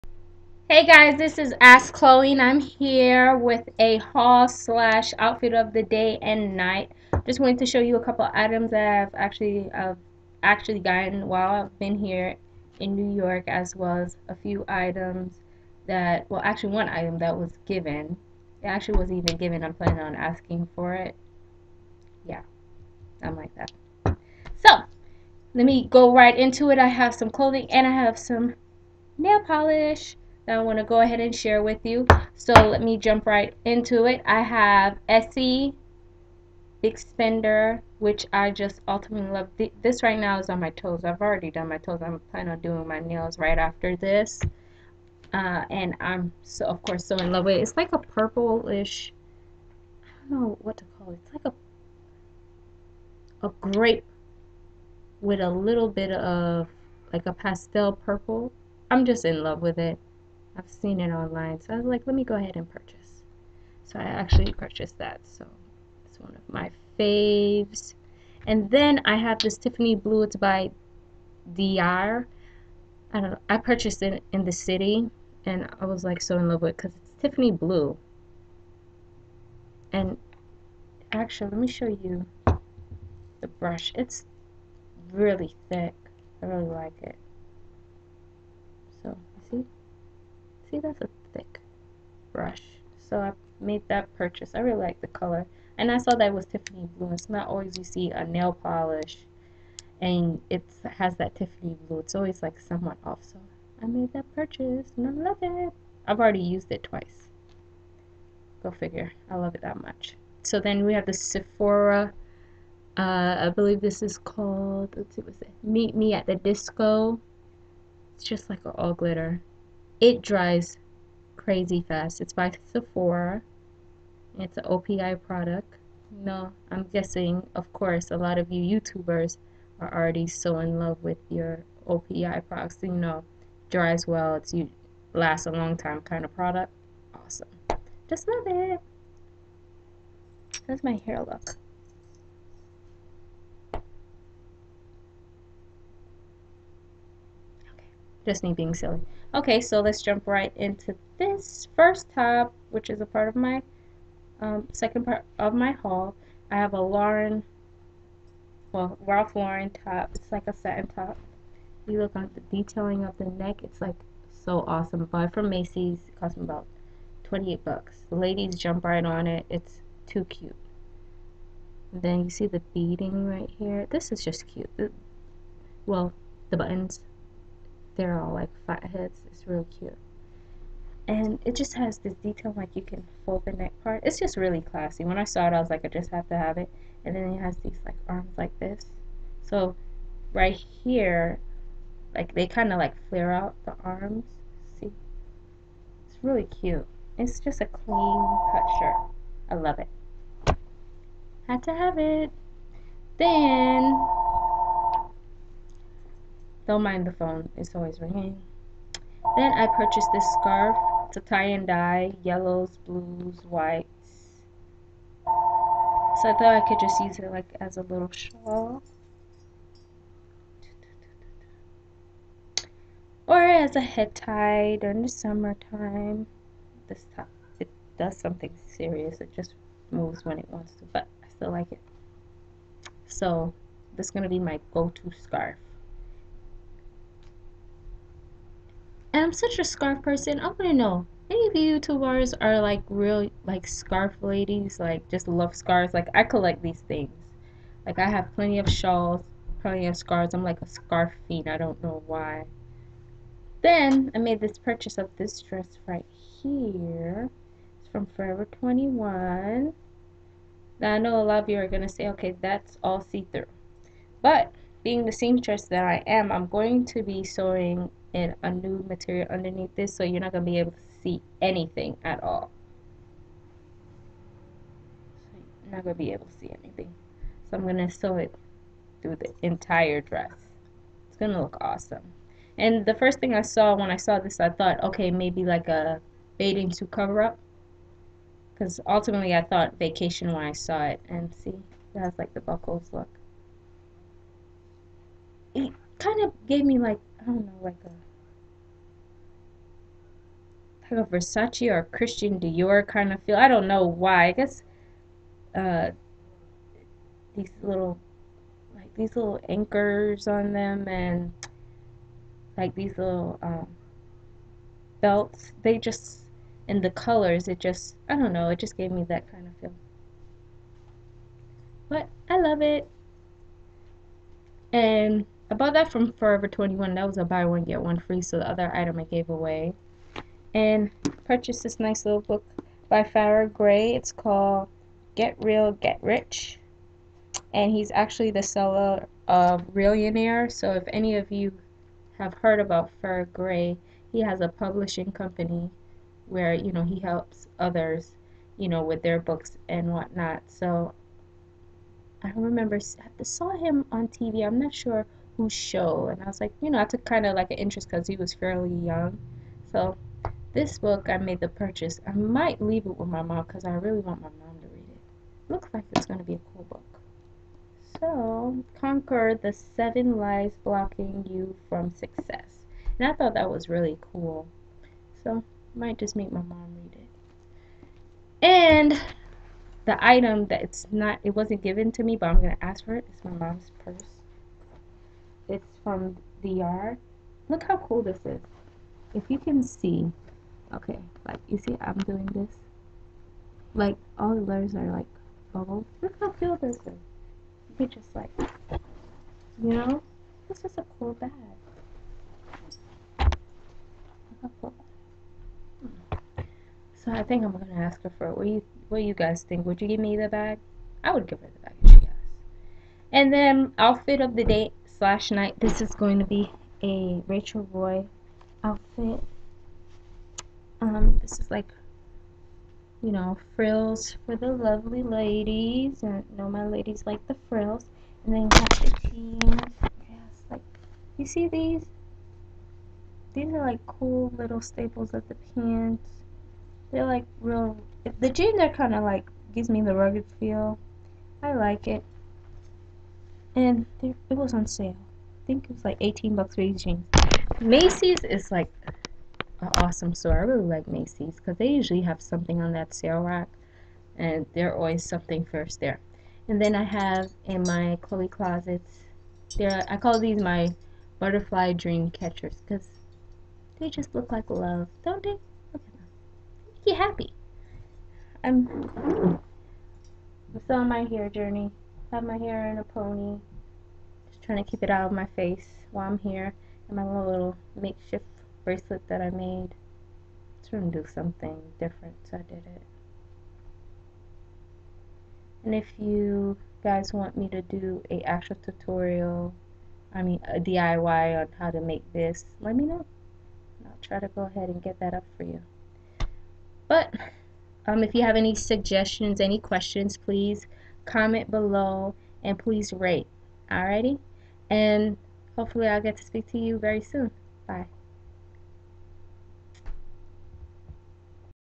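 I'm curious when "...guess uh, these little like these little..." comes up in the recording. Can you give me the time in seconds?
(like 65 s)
304 s.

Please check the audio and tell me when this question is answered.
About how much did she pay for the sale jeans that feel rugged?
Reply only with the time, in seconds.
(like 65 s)
445 s.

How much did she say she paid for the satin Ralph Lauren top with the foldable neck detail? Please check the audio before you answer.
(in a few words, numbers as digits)
28 bucks.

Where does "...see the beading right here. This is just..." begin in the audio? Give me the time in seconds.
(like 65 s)
172 s.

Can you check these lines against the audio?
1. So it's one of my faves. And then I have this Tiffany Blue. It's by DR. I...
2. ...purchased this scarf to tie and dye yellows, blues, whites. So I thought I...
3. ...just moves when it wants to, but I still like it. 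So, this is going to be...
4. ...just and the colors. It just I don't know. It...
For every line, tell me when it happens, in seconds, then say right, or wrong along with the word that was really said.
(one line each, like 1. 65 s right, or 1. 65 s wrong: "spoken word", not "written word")
1. 65 s right
2. 209 s right
3. 229 s right
4. 315 s right.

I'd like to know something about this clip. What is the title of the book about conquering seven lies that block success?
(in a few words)
Get Real, Get Rich.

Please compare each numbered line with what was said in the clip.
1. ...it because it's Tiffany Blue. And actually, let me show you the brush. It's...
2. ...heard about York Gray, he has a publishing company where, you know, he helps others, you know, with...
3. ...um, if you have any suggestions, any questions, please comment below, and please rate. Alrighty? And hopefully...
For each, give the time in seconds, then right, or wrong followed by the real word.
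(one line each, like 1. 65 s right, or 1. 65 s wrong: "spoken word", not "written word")
1. 76 s right
2. 342 s wrong: "Farrah", not "York"
3. 497 s right.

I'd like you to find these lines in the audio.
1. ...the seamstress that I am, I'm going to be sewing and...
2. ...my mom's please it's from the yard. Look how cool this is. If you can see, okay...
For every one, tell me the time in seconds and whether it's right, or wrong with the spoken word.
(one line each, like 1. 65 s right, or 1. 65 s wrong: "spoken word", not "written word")
1. 265 s right
2. 383 s wrong: "purse", not "please".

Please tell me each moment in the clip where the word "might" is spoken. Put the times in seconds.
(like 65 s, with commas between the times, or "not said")
362 s, 375 s.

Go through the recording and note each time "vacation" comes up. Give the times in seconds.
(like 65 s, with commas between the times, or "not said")
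289 s.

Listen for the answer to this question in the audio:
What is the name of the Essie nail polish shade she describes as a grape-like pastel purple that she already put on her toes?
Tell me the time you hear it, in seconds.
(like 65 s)
36 s.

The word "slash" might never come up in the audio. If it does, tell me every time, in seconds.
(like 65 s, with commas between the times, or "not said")
4 s, 415 s.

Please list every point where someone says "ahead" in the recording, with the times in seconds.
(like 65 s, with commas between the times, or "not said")
31 s, 62 s, 494 s.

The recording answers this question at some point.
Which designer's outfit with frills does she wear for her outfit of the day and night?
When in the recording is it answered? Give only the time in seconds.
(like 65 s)
417 s.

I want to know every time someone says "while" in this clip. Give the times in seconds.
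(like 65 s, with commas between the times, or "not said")
11 s, 475 s.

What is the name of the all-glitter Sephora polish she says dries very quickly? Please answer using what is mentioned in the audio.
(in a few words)
Meet Me at the Disco.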